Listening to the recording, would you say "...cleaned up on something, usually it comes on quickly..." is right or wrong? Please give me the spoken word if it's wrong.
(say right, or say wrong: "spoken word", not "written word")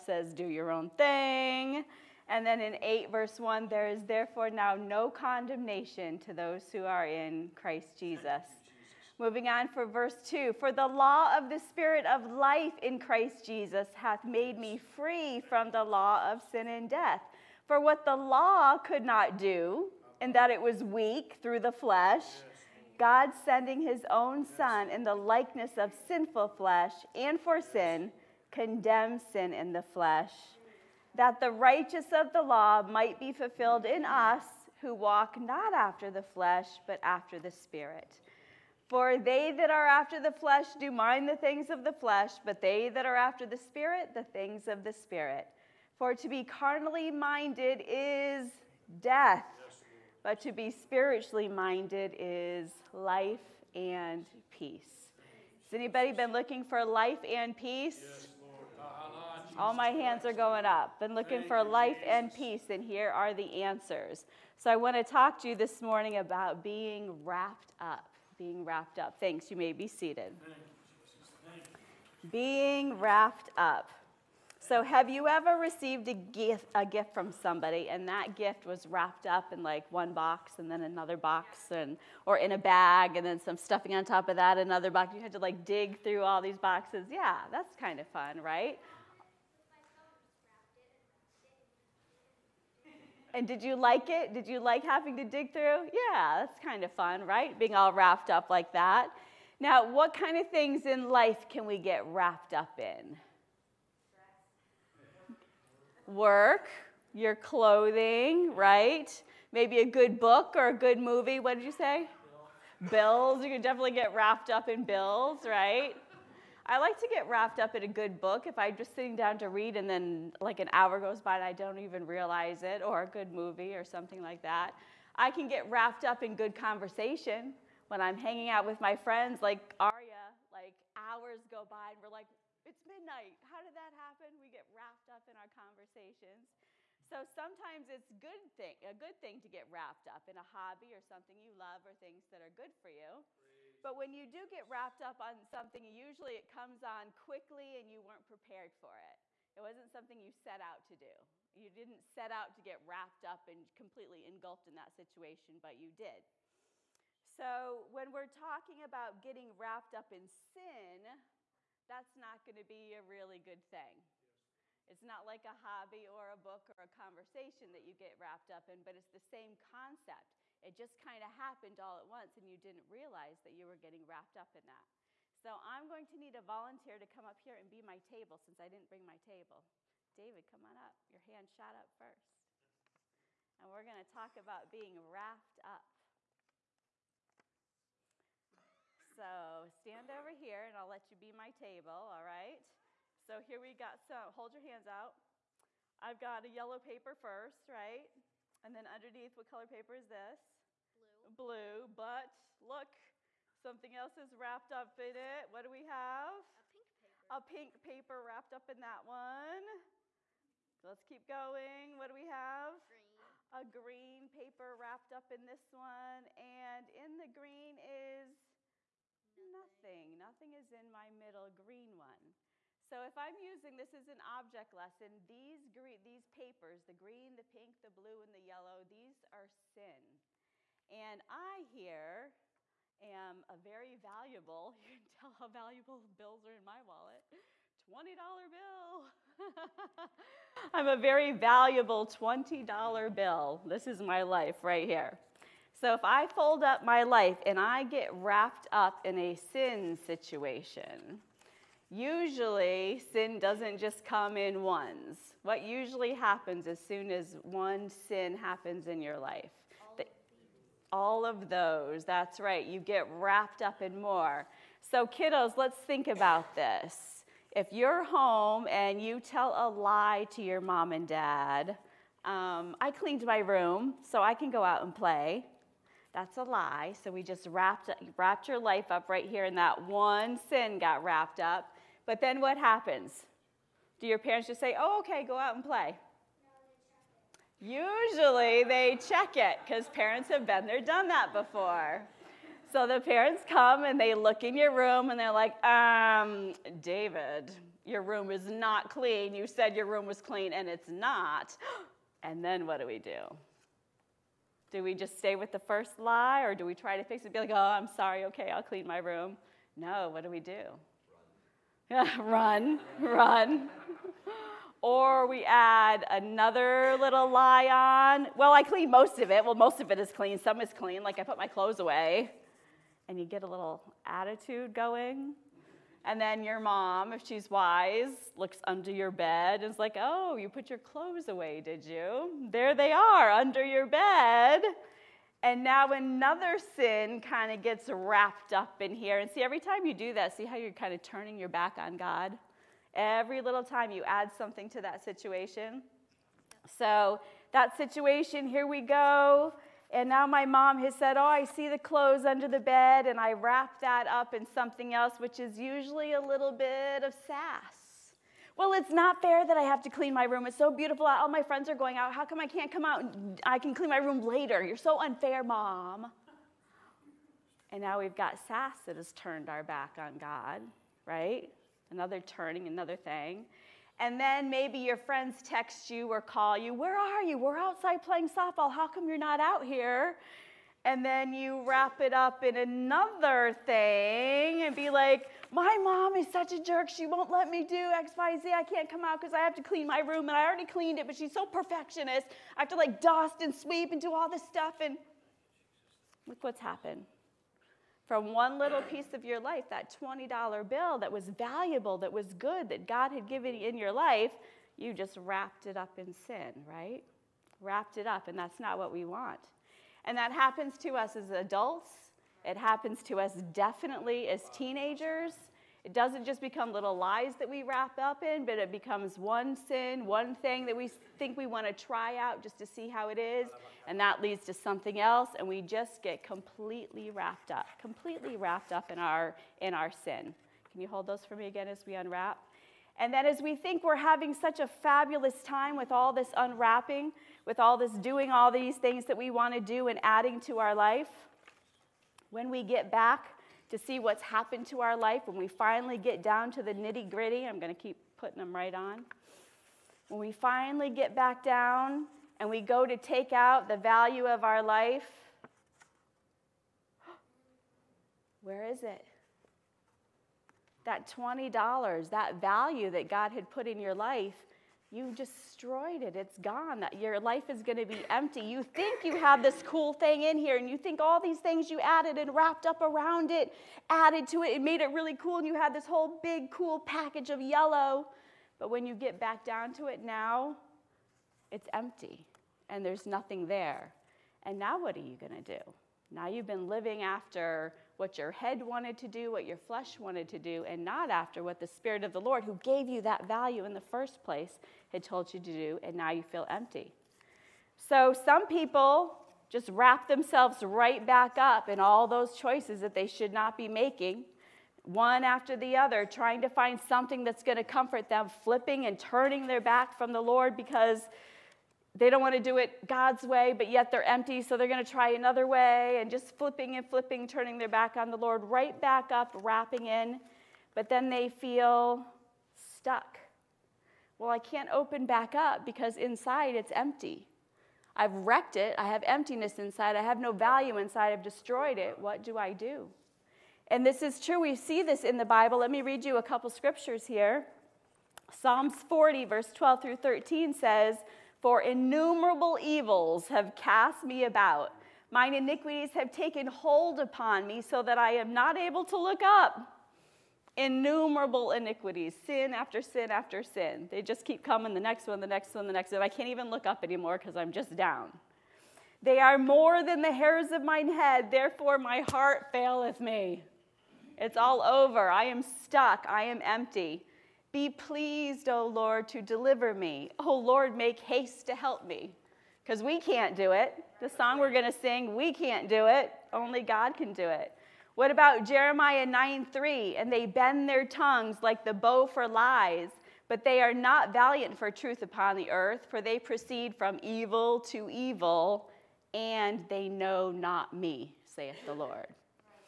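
wrong: "wrapped", not "cleaned".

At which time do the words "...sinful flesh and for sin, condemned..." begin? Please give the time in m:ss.
0:26.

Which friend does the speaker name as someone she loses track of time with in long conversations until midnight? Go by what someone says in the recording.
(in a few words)
Aria.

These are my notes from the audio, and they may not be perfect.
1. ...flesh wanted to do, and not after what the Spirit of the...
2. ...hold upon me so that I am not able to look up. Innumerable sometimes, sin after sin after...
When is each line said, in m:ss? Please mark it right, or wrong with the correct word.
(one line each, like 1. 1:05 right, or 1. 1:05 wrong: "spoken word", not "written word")
1. 8:09 right
2. 9:06 wrong: "iniquities", not "sometimes".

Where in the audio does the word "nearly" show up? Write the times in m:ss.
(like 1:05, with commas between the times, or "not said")
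not said.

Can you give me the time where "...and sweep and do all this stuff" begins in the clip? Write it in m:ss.
6:33.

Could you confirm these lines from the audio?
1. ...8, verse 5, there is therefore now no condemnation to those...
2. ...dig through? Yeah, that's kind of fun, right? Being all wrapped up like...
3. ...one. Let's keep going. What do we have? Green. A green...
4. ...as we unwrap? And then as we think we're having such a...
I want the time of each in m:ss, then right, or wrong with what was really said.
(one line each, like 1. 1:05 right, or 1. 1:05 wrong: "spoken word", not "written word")
1. 0:02 wrong: "1", not "5"
2. 1:35 right
3. 3:29 right
4. 7:11 right.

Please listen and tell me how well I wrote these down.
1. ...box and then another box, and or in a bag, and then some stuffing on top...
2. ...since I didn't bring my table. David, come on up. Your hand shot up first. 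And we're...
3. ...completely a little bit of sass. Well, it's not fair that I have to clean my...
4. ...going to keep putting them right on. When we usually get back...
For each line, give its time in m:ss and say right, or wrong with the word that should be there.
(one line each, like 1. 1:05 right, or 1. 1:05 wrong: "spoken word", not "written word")
1. 1:20 right
2. 2:58 right
3. 5:55 wrong: "usually", not "completely"
4. 7:27 wrong: "finally", not "usually".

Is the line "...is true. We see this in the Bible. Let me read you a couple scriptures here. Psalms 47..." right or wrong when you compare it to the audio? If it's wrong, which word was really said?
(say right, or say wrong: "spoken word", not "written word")
wrong: "40", not "47".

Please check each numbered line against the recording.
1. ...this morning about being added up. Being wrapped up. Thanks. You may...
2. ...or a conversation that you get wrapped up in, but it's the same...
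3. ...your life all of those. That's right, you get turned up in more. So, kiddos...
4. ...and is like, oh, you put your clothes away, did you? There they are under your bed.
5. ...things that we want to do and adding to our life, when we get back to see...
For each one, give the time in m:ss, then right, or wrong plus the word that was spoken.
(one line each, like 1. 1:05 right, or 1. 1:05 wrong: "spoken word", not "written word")
1. 1:05 wrong: "wrapped", not "added"
2. 2:46 right
3. 4:19 wrong: "wrapped", not "turned"
4. 5:29 right
5. 7:18 right.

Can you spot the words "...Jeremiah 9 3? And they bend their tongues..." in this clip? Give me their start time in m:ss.
9:38.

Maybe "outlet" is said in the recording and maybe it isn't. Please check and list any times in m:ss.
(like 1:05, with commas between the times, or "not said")
not said.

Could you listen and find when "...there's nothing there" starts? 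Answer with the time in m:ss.
8:02.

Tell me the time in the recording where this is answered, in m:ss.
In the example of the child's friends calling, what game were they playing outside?
6:18.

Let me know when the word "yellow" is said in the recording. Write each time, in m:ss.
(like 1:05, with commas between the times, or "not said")
3:16, 3:48, 7:57.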